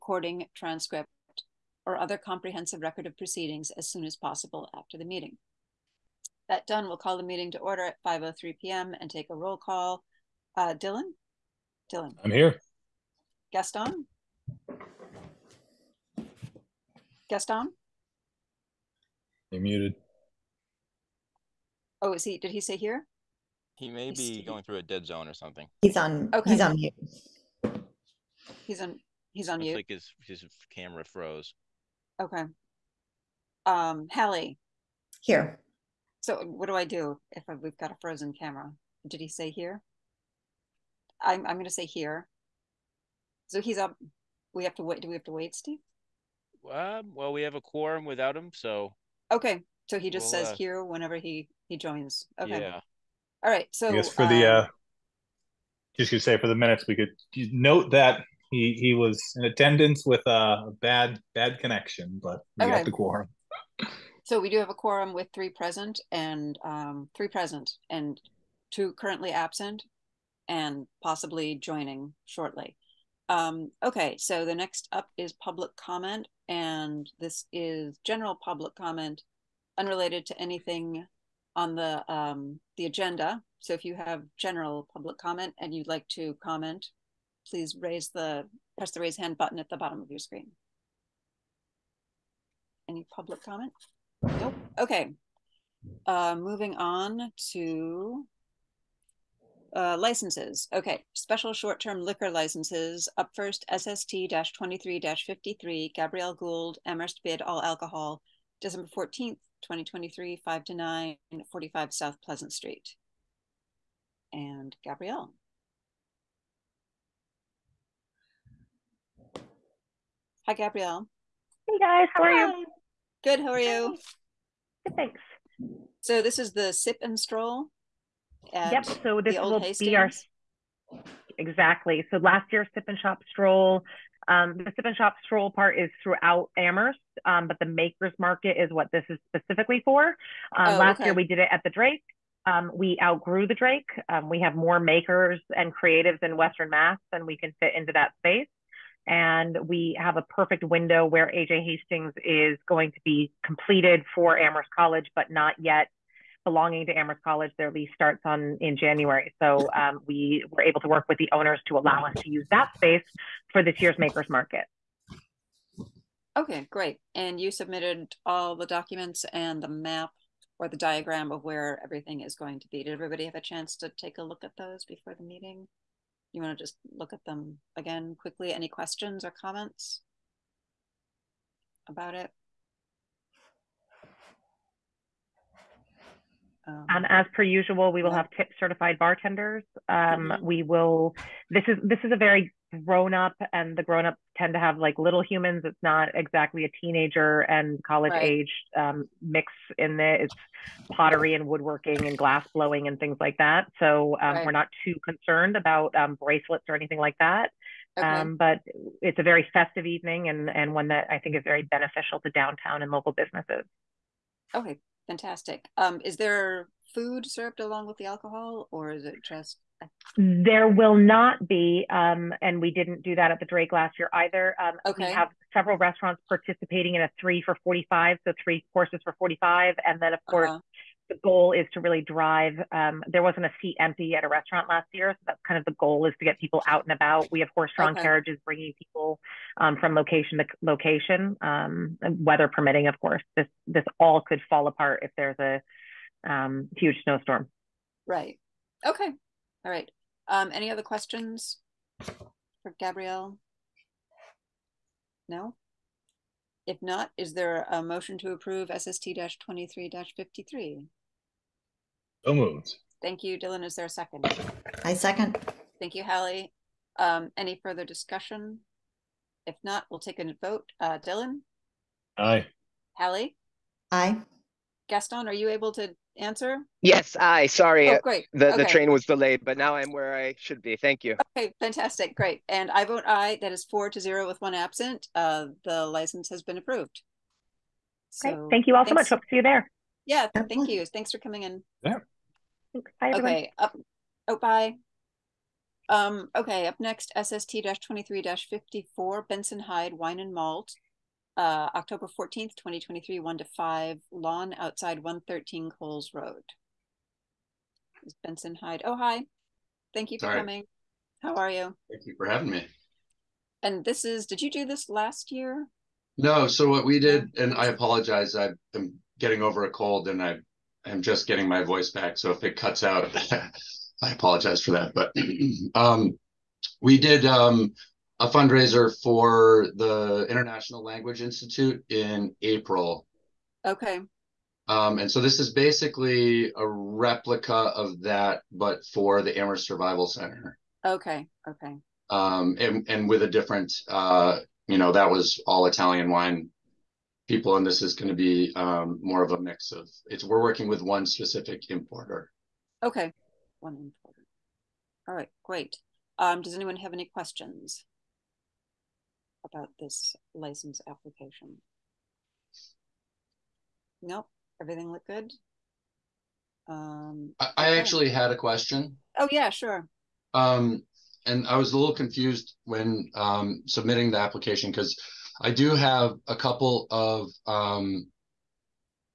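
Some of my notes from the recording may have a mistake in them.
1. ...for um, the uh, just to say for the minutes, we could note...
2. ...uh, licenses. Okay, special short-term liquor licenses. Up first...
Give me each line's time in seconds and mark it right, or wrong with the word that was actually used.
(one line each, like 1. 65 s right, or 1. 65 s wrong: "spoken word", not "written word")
1. 54 s right
2. 99 s right.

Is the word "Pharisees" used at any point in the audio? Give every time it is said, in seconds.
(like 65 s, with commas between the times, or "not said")
not said.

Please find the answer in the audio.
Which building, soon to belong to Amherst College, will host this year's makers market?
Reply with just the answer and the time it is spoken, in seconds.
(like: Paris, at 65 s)
AJ Hastings, at 151 s.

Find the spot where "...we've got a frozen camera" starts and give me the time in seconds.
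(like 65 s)
37 s.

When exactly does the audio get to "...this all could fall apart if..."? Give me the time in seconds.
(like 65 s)
243 s.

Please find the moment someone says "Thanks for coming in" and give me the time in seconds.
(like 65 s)
290 s.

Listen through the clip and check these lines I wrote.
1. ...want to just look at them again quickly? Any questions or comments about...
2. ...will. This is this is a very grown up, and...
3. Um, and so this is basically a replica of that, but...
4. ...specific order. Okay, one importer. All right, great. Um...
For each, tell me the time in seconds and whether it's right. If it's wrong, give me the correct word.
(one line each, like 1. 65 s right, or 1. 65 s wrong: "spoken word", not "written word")
1. 176 s right
2. 190 s right
3. 334 s right
4. 351 s wrong: "importer", not "order".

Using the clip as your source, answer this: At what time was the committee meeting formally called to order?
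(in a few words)
5:03 p.m.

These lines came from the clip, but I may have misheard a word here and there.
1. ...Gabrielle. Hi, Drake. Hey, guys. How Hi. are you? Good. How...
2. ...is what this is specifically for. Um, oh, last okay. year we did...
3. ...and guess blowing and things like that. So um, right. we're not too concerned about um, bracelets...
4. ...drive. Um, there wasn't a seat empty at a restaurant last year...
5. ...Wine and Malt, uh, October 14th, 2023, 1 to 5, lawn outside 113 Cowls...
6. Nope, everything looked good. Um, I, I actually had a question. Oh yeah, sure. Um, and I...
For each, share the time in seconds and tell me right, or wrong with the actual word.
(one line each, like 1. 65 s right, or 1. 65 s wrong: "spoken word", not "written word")
1. 114 s wrong: "Gabrielle", not "Drake"
2. 138 s right
3. 202 s wrong: "glass", not "guess"
4. 232 s right
5. 299 s right
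6. 364 s right.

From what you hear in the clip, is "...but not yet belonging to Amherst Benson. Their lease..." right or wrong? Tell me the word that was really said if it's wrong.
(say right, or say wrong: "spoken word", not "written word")
wrong: "College", not "Benson".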